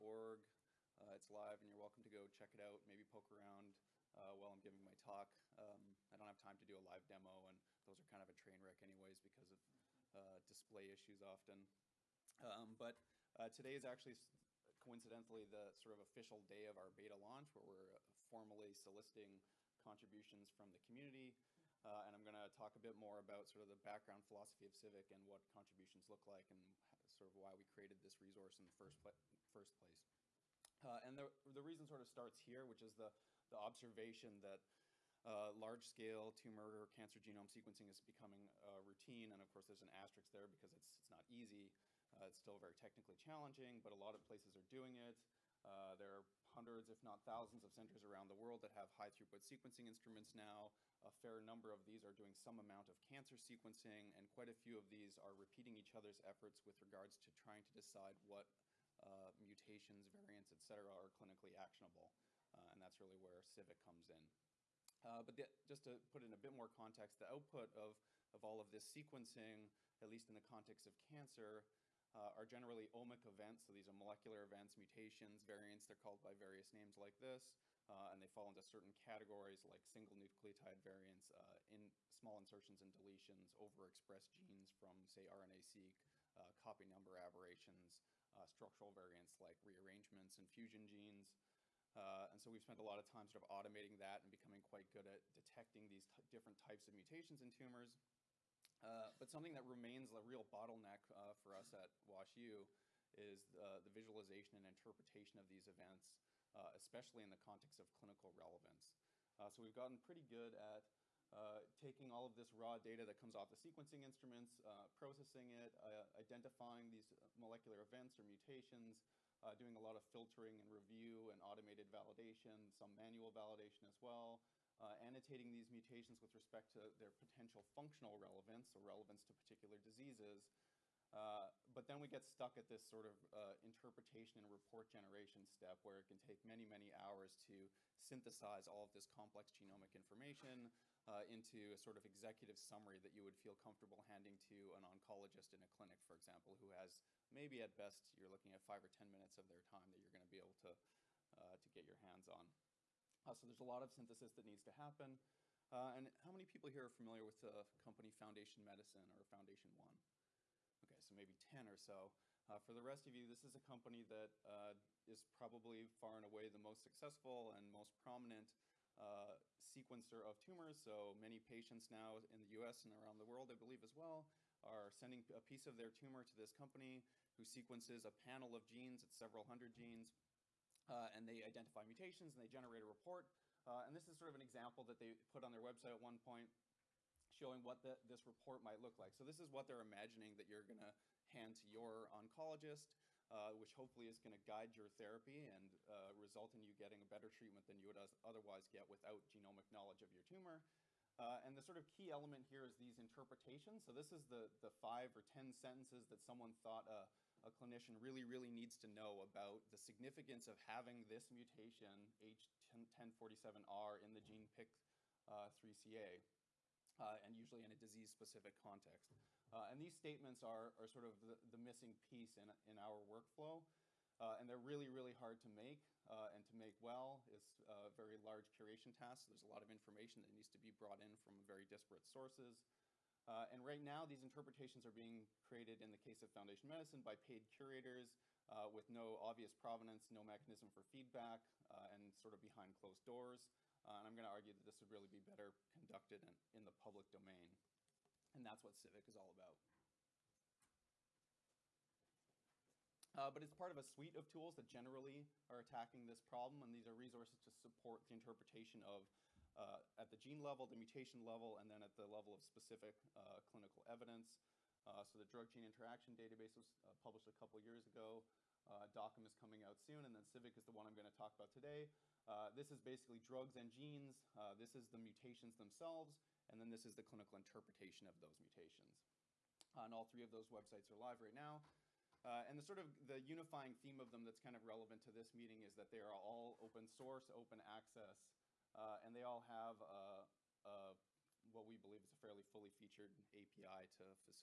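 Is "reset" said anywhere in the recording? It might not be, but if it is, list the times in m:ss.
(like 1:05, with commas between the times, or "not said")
not said.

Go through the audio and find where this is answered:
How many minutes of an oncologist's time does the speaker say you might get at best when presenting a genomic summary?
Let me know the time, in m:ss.
2:28.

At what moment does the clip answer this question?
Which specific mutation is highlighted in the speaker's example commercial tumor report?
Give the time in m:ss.
3:32.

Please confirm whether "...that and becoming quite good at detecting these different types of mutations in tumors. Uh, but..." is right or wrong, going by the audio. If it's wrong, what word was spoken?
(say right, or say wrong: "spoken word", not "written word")
right.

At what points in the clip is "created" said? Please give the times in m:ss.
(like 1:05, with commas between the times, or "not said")
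0:27, 3:55.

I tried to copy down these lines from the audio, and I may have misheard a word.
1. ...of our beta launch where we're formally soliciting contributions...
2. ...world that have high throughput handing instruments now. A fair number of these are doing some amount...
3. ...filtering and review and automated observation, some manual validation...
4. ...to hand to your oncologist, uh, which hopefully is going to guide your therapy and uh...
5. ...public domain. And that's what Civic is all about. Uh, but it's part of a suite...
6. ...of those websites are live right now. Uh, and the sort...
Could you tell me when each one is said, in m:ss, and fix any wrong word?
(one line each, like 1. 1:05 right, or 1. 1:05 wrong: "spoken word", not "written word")
1. 0:16 right
2. 0:48 wrong: "sequencing", not "handing"
3. 2:00 wrong: "validation", not "observation"
4. 3:10 right
5. 4:06 right
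6. 4:40 right.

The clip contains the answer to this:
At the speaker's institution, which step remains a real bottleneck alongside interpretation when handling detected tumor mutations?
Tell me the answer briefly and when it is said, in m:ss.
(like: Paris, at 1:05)
Visualization, at 1:43.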